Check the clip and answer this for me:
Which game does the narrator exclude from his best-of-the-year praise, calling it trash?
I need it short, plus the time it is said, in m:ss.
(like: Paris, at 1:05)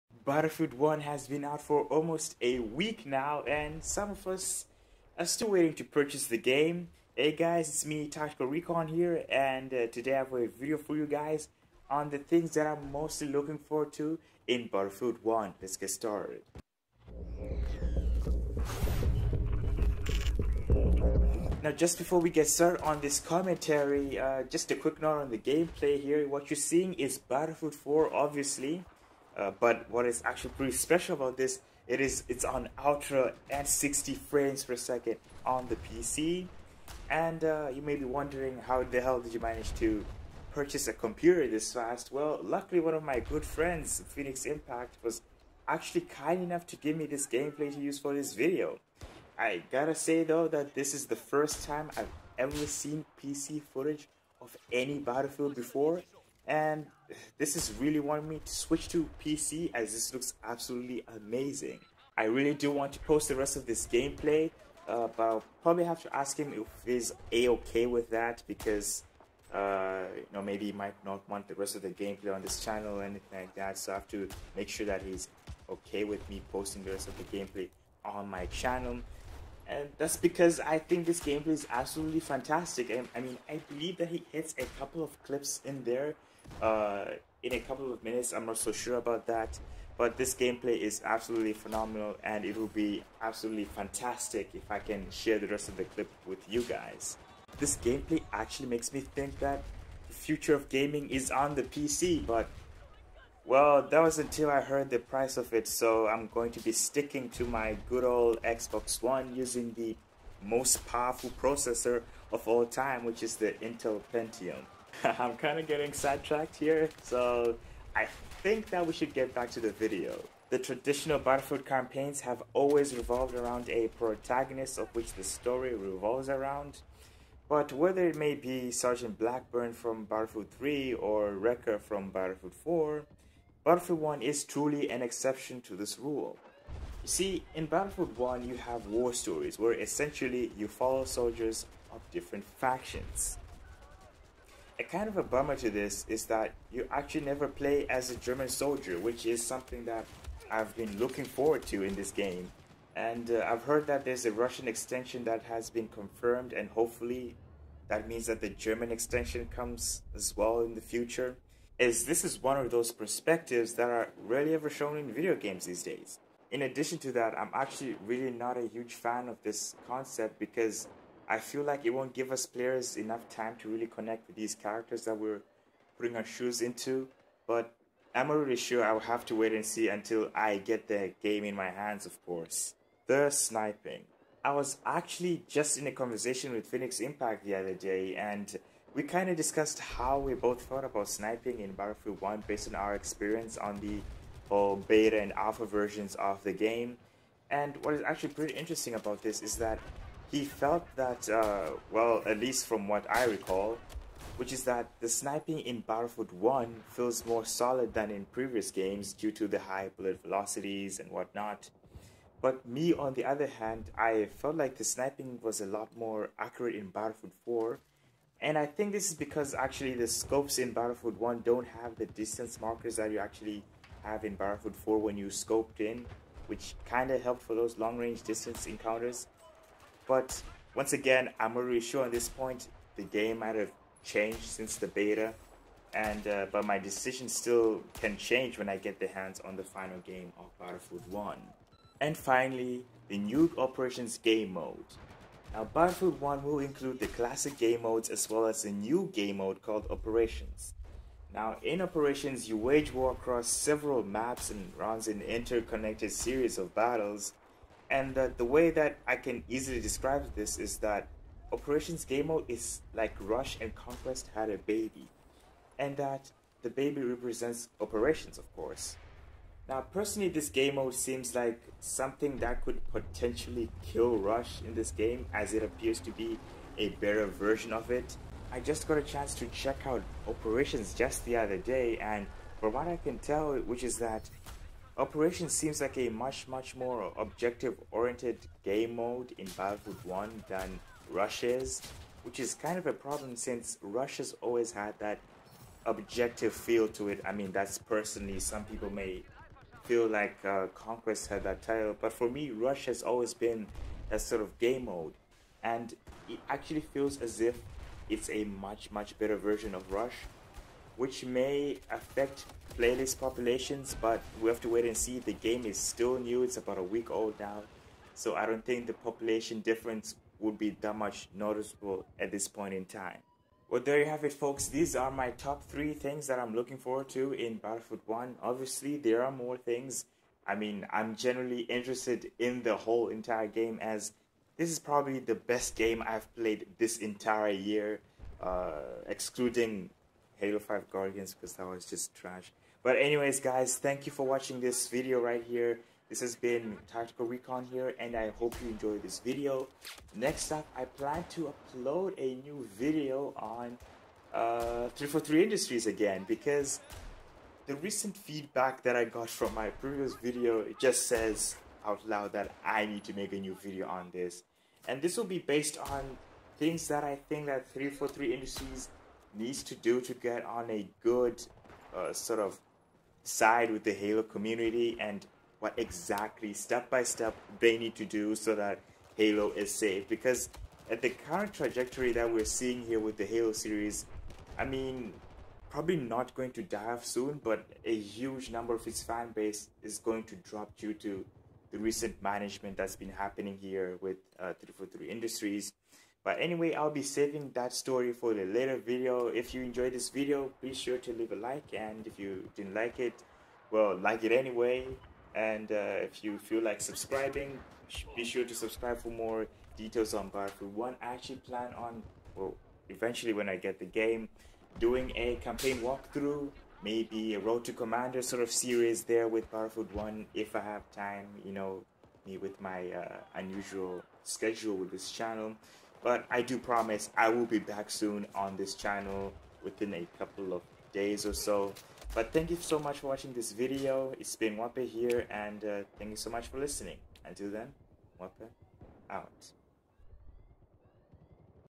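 Halo 5 Guardians, at 5:40.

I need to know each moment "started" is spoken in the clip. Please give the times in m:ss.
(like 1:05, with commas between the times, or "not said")
0:15, 0:22.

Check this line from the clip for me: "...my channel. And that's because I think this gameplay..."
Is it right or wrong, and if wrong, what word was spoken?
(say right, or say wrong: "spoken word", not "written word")
right.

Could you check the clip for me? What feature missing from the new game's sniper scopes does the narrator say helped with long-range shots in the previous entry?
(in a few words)
Distance markers.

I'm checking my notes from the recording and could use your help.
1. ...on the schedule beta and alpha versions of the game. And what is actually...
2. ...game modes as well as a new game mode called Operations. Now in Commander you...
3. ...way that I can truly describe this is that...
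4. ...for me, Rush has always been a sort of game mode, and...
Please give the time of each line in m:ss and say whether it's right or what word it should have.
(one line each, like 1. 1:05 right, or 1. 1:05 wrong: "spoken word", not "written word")
1. 3:13 wrong: "whole", not "schedule"
2. 4:07 wrong: "Operations", not "Commander"
3. 4:18 wrong: "easily", not "truly"
4. 5:02 right.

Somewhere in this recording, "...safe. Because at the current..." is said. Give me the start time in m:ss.
6:19.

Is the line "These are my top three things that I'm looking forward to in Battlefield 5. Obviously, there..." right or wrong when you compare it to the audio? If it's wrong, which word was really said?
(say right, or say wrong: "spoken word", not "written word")
wrong: "1", not "5".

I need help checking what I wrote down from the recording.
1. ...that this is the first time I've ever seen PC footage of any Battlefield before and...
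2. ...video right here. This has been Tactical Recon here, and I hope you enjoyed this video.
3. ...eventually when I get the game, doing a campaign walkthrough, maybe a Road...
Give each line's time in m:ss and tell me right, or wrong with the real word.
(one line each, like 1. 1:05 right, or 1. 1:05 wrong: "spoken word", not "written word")
1. 0:50 right
2. 5:44 right
3. 6:52 right.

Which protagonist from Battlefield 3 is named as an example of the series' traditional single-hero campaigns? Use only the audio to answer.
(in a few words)
Sergeant Blackburn.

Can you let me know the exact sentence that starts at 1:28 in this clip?
I'm not so sure about that.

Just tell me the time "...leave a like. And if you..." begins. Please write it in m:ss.
6:41.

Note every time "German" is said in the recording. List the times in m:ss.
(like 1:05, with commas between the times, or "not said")
2:28, 2:38.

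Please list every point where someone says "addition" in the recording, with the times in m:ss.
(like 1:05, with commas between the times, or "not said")
2:46.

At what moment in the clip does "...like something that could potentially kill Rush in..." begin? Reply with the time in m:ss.
4:31.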